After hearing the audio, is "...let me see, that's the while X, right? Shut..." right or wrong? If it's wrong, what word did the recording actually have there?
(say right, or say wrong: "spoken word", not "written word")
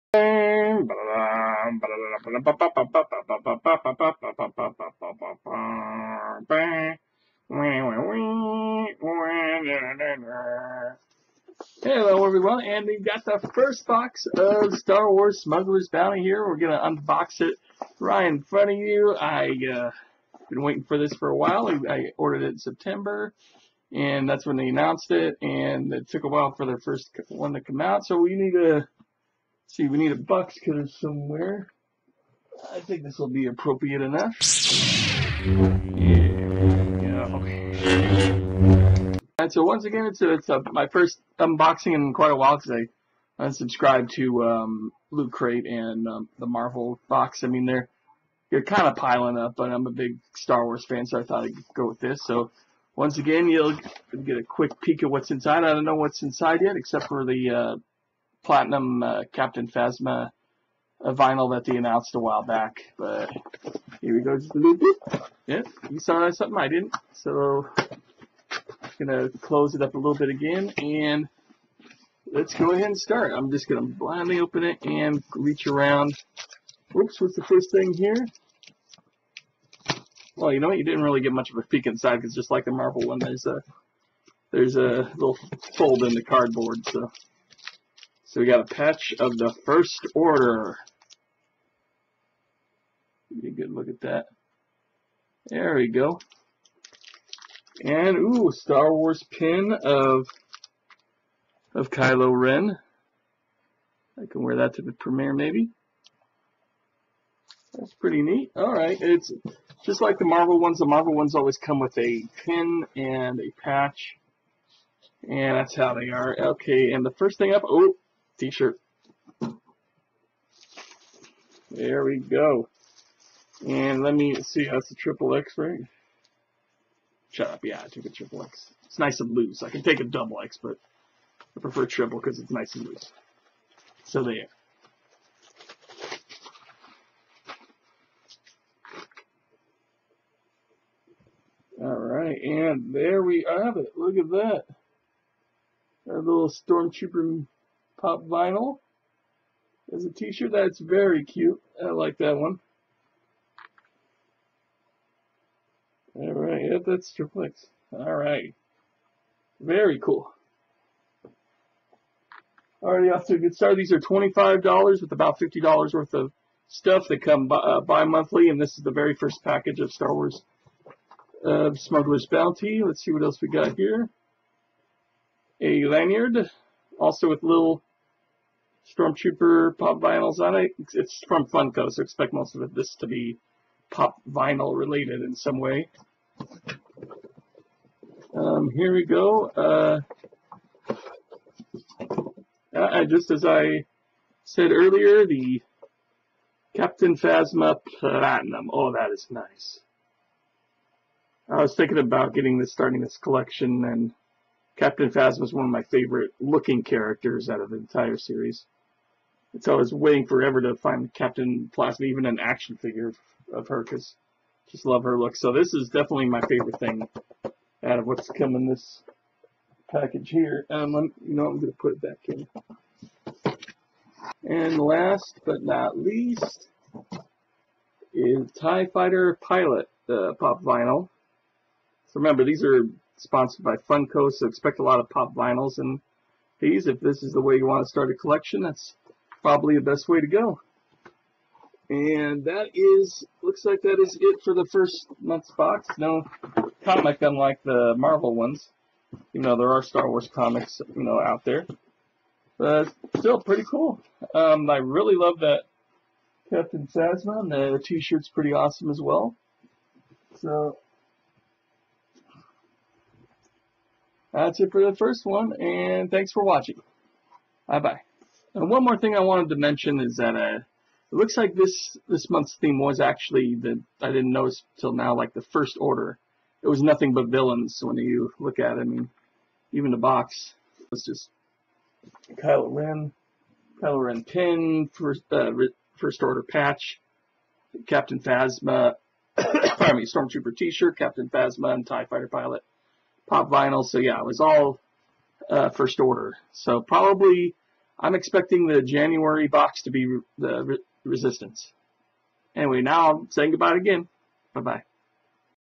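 wrong: "triple", not "while".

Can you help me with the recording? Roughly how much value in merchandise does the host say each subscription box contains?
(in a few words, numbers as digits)
$50.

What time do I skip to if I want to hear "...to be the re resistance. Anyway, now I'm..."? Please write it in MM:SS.
04:59.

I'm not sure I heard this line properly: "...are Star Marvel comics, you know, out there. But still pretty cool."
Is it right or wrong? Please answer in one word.
wrong.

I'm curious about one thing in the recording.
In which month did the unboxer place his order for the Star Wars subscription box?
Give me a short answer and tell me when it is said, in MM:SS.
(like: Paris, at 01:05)
September, at 00:22.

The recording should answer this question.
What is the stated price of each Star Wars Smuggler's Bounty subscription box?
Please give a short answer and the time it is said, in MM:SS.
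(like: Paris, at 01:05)
$25, at 02:43.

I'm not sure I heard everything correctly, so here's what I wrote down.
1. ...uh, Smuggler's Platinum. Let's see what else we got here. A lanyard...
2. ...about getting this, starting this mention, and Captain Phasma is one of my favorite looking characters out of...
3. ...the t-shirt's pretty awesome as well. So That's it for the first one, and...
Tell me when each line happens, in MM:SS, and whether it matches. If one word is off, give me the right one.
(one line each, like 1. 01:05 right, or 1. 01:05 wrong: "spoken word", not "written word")
1. 02:51 wrong: "Bounty", not "Platinum"
2. 03:21 wrong: "collection", not "mention"
3. 04:17 right.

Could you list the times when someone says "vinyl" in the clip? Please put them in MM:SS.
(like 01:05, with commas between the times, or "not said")
01:01, 02:28, 02:59, 03:04, 03:50, 03:55, 04:53.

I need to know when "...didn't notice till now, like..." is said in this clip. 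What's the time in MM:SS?
04:34.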